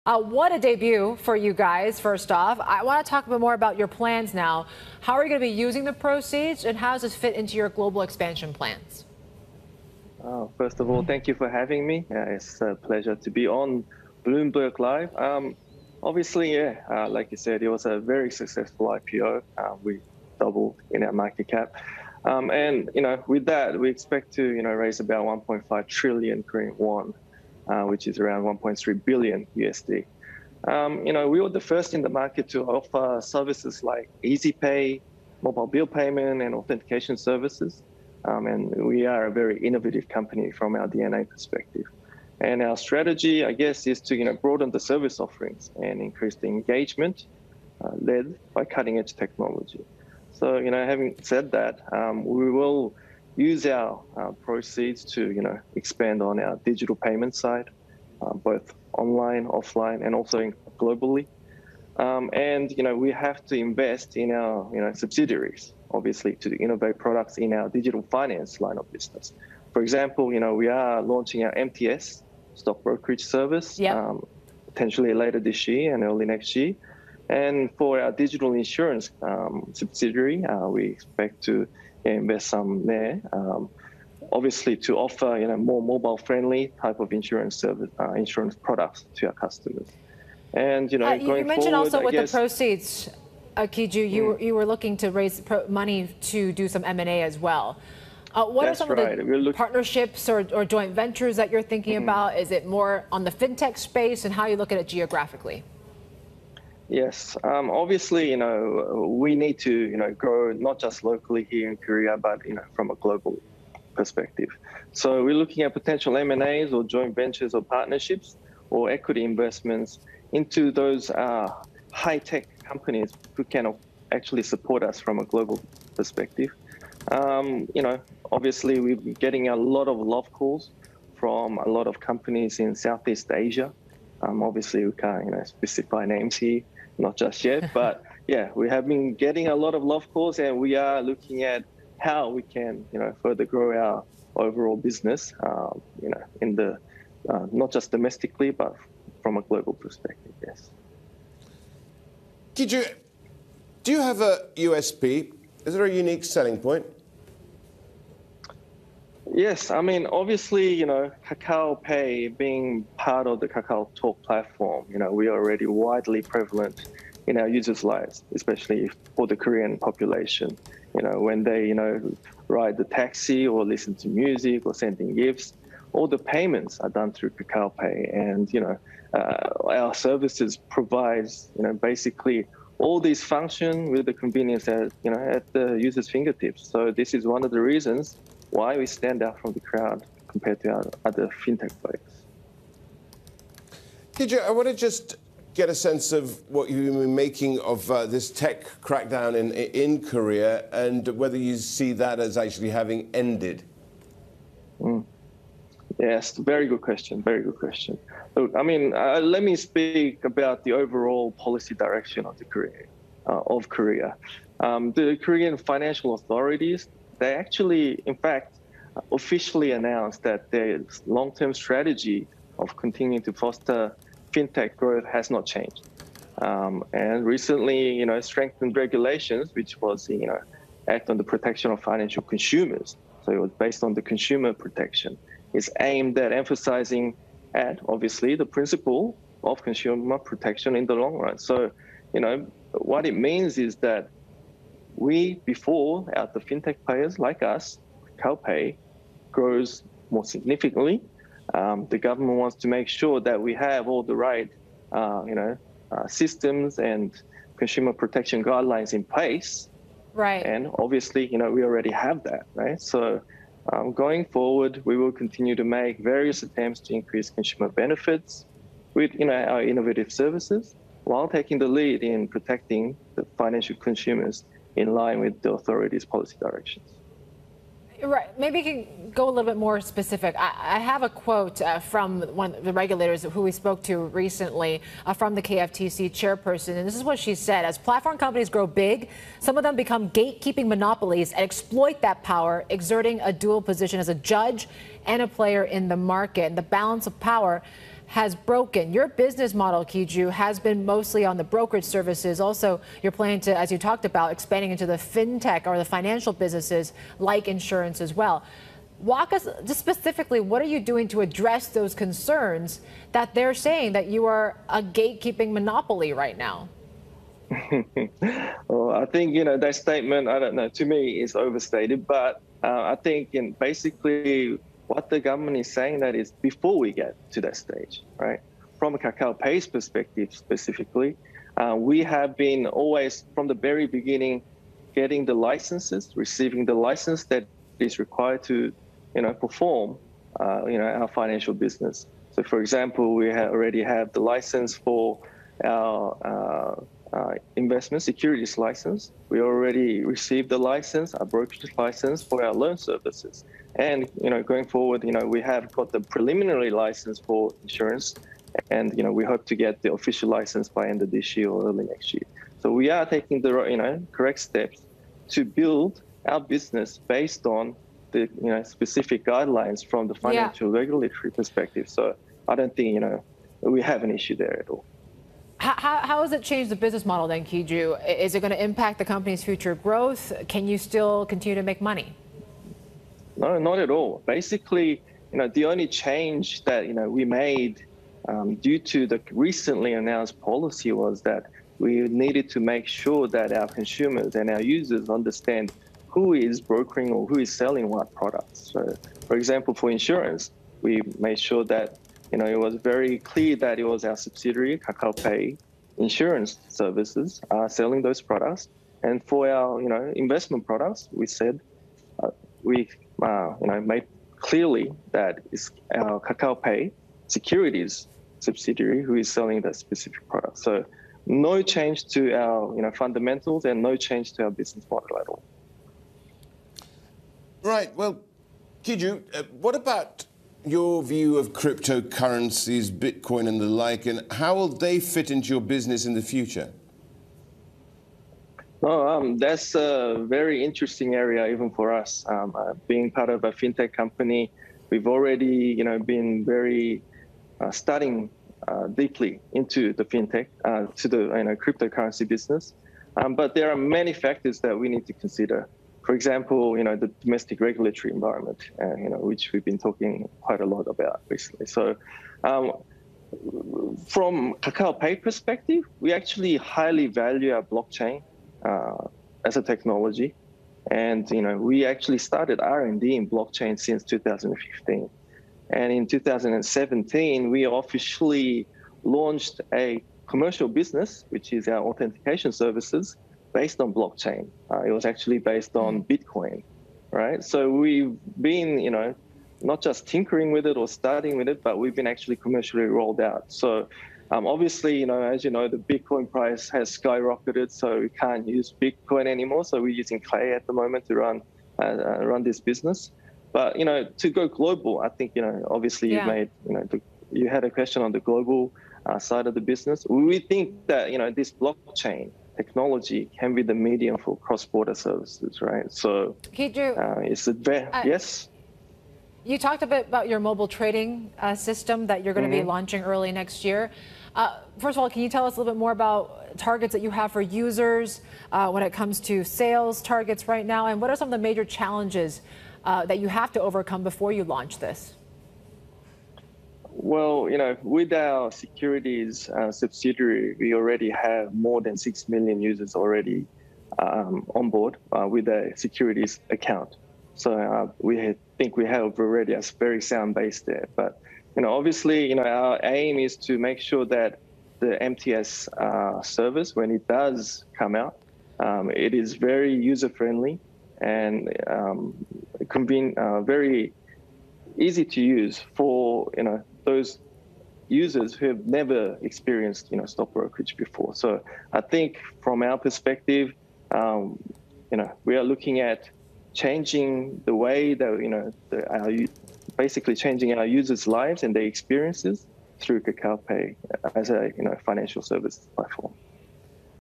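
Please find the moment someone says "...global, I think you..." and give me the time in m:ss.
8:24.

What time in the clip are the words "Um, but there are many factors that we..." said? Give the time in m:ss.
7:33.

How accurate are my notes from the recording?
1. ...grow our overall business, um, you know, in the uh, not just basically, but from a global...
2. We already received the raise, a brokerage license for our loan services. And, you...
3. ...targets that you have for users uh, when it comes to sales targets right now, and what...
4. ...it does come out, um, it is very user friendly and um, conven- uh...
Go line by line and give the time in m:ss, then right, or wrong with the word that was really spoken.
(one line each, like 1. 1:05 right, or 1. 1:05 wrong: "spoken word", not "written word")
1. 2:23 wrong: "domestically", not "basically"
2. 5:49 wrong: "license", not "raise"
3. 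8:46 right
4. 9:16 right.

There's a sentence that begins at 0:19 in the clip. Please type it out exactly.
Uh, we doubled in our market cap.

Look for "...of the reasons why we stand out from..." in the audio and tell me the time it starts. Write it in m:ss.
3:07.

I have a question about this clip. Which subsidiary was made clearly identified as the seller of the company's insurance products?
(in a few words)
Kakao Pay Insurance Services.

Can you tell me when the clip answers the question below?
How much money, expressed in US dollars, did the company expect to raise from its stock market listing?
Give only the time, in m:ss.
0:28.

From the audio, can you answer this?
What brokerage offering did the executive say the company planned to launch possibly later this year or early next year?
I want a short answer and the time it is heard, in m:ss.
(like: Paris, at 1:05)
MTS stock brokerage service, at 1:11.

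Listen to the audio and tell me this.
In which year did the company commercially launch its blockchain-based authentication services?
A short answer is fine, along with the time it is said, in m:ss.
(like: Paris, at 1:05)
2017, at 7:56.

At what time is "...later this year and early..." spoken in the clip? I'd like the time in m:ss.
1:15.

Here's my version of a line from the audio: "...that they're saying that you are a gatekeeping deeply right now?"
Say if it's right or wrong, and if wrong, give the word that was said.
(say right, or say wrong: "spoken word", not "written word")
wrong: "monopoly", not "deeply".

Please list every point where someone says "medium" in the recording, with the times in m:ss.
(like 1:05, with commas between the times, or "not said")
8:33.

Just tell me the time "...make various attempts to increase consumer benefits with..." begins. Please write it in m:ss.
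4:25.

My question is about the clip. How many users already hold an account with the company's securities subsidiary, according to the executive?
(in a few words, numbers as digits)
6 million.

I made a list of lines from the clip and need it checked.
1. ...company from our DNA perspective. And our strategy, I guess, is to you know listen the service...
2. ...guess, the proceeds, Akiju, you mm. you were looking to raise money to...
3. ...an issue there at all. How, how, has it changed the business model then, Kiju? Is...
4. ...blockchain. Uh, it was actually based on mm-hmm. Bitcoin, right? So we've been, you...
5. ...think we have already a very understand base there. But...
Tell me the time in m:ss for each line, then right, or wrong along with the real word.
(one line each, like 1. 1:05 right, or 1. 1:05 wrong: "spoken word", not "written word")
1. 0:40 wrong: "broaden", not "listen"
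2. 1:32 right
3. 6:14 right
4. 8:03 right
5. 9:08 wrong: "sound", not "understand".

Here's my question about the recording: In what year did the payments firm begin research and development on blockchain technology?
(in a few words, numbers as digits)
2015.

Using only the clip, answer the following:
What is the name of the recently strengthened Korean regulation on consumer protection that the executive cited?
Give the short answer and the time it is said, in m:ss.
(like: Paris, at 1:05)
Act on the Protection of Financial Consumers, at 3:50.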